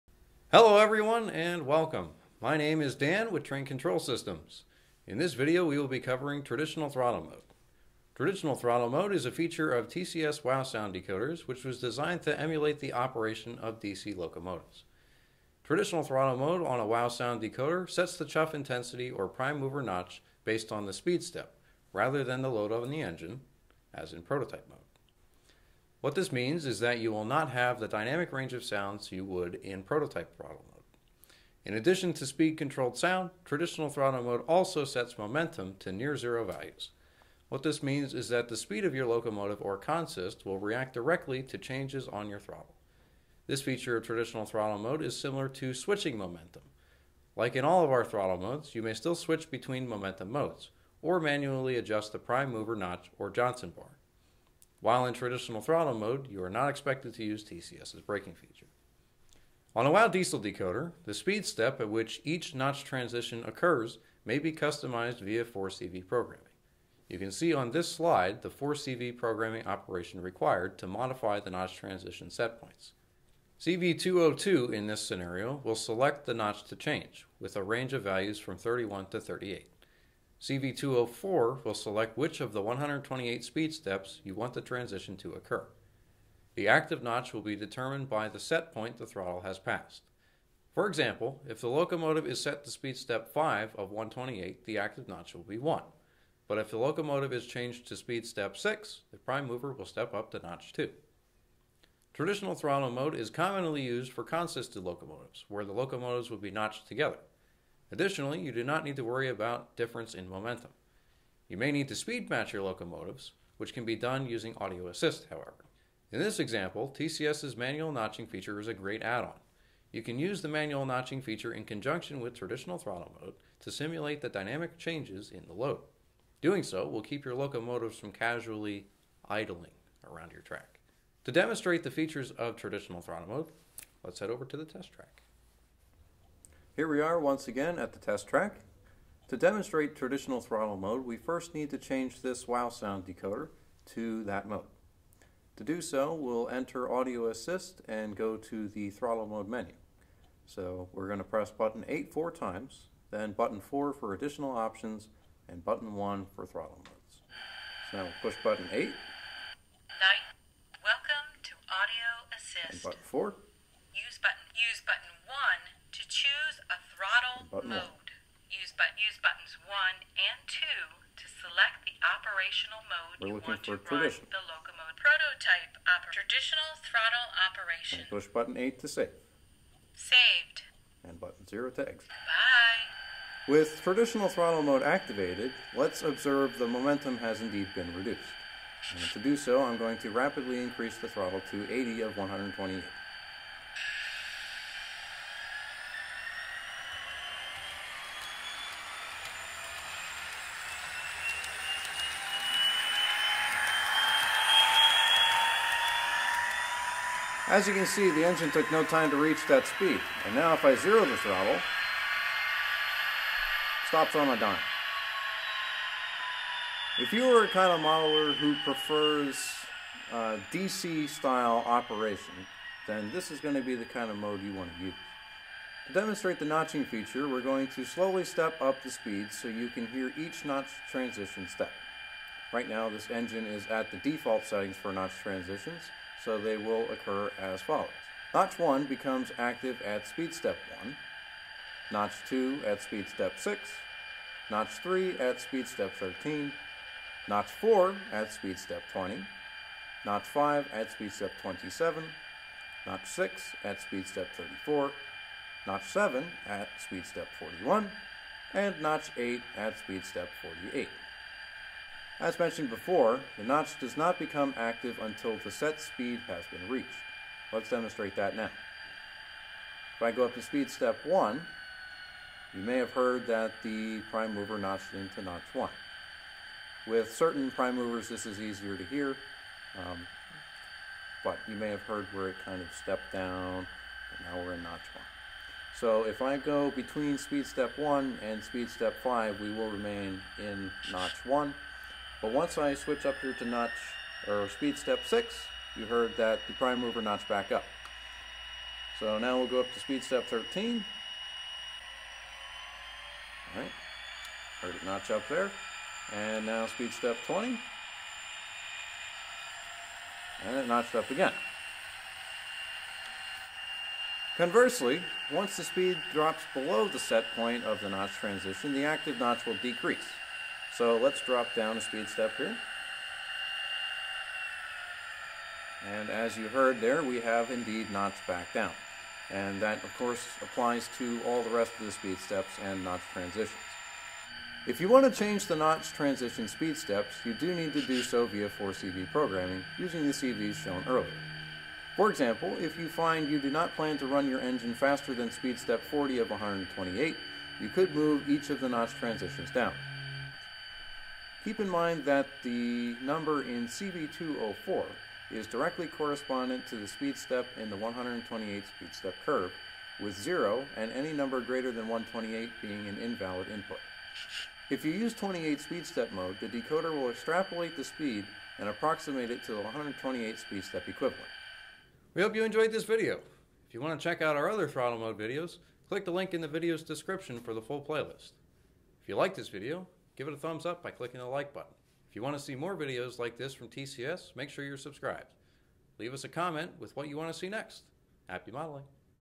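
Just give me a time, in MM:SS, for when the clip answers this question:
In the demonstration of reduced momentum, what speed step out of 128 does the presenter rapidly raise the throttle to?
03:11.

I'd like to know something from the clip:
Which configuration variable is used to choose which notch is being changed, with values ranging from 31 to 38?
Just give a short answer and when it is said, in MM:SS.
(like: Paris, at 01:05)
CV202, at 01:13.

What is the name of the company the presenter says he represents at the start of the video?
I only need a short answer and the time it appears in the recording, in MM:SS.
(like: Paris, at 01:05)
Train Control Systems, at 00:03.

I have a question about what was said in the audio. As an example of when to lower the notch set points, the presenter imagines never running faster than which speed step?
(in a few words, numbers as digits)
40.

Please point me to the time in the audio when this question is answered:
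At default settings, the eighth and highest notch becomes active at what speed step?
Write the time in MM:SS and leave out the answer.
04:19.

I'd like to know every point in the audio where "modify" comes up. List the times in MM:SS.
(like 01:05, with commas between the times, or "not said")
01:10.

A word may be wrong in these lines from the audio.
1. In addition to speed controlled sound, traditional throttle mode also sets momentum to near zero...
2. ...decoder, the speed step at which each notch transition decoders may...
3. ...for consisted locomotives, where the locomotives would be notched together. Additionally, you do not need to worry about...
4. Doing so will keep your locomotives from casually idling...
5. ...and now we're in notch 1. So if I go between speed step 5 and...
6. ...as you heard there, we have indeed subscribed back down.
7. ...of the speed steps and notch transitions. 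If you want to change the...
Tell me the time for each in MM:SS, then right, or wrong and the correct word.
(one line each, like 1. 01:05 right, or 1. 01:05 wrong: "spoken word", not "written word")
1. 00:31 right
2. 01:00 wrong: "occurs", not "decoders"
3. 01:44 right
4. 02:06 right
5. 04:44 wrong: "1", not "5"
6. 05:26 wrong: "notched", not "subscribed"
7. 05:31 right.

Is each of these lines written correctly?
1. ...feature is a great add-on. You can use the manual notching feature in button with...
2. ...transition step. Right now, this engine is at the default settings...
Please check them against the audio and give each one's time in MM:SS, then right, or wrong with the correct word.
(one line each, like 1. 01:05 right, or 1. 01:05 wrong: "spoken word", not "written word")
1. 01:58 wrong: "conjunction", not "button"
2. 03:50 right.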